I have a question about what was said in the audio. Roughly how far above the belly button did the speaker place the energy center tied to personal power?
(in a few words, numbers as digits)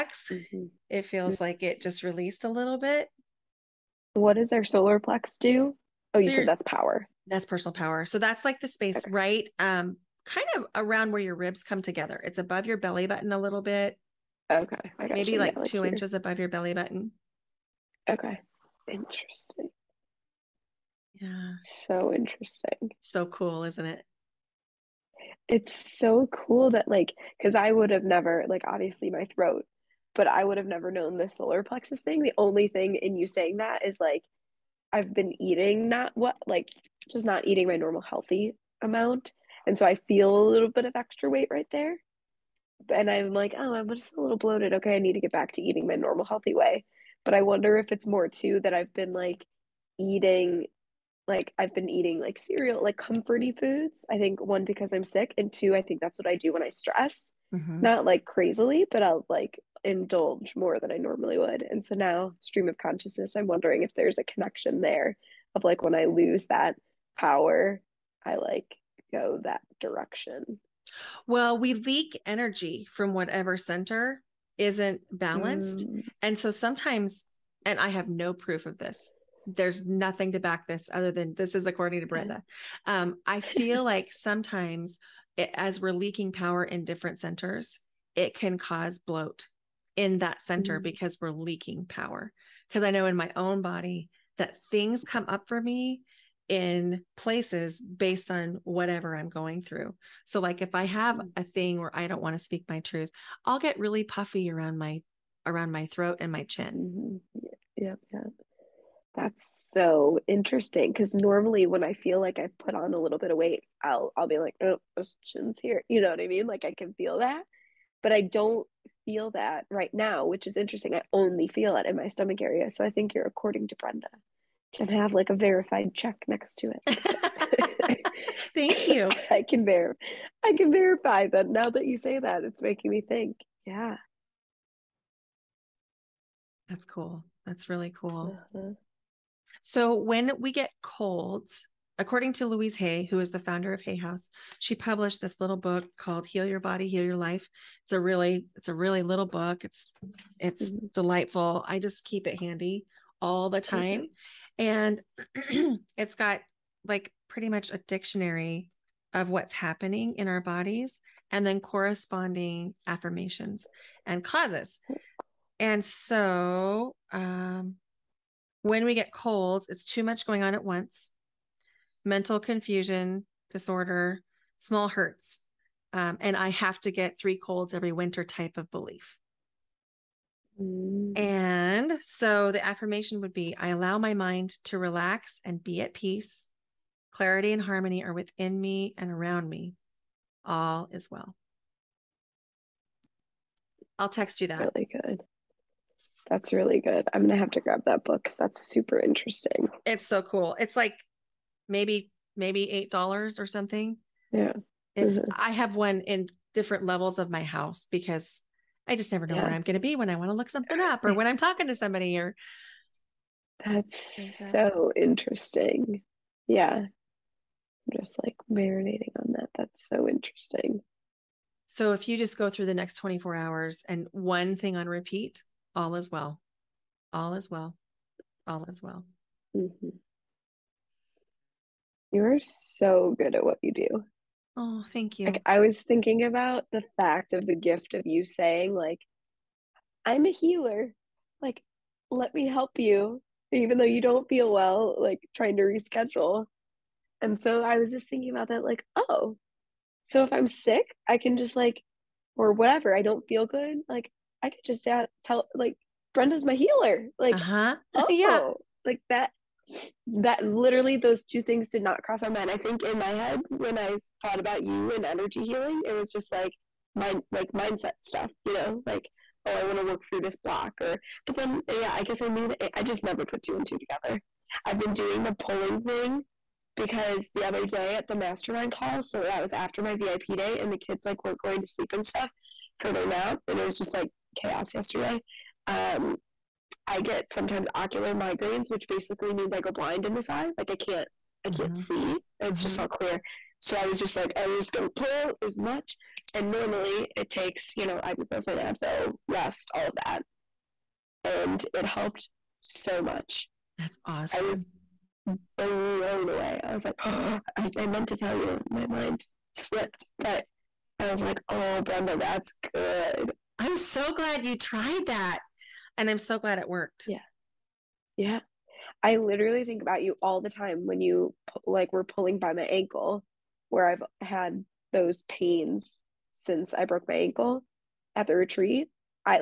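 2 inches.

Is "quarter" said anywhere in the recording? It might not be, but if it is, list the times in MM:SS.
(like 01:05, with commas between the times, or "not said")
not said.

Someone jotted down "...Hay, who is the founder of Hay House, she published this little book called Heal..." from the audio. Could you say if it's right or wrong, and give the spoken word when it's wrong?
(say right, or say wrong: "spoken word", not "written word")
right.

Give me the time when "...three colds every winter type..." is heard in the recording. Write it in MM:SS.
02:57.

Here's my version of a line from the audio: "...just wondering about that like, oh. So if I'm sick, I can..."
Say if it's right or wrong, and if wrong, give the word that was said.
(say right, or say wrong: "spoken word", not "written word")
wrong: "thinking", not "wondering".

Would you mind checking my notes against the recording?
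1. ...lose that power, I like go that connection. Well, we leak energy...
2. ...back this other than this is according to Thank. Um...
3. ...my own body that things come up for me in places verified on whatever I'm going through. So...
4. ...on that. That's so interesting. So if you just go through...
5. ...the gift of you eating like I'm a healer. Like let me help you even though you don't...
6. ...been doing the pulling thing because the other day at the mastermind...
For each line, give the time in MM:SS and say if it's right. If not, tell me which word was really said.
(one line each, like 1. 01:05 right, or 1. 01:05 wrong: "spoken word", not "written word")
1. 01:06 wrong: "direction", not "connection"
2. 01:20 wrong: "Brenda", not "Thank"
3. 01:33 wrong: "based", not "verified"
4. 03:39 right
5. 03:57 wrong: "saying", not "eating"
6. 04:34 right.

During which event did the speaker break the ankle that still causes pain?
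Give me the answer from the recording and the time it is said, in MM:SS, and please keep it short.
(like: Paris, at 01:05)
the retreat, at 05:28.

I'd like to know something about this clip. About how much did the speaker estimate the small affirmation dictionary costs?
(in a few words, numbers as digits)
$8.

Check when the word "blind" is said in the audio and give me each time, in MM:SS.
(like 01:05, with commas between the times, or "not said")
04:49.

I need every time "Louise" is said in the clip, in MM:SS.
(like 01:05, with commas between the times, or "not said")
02:22.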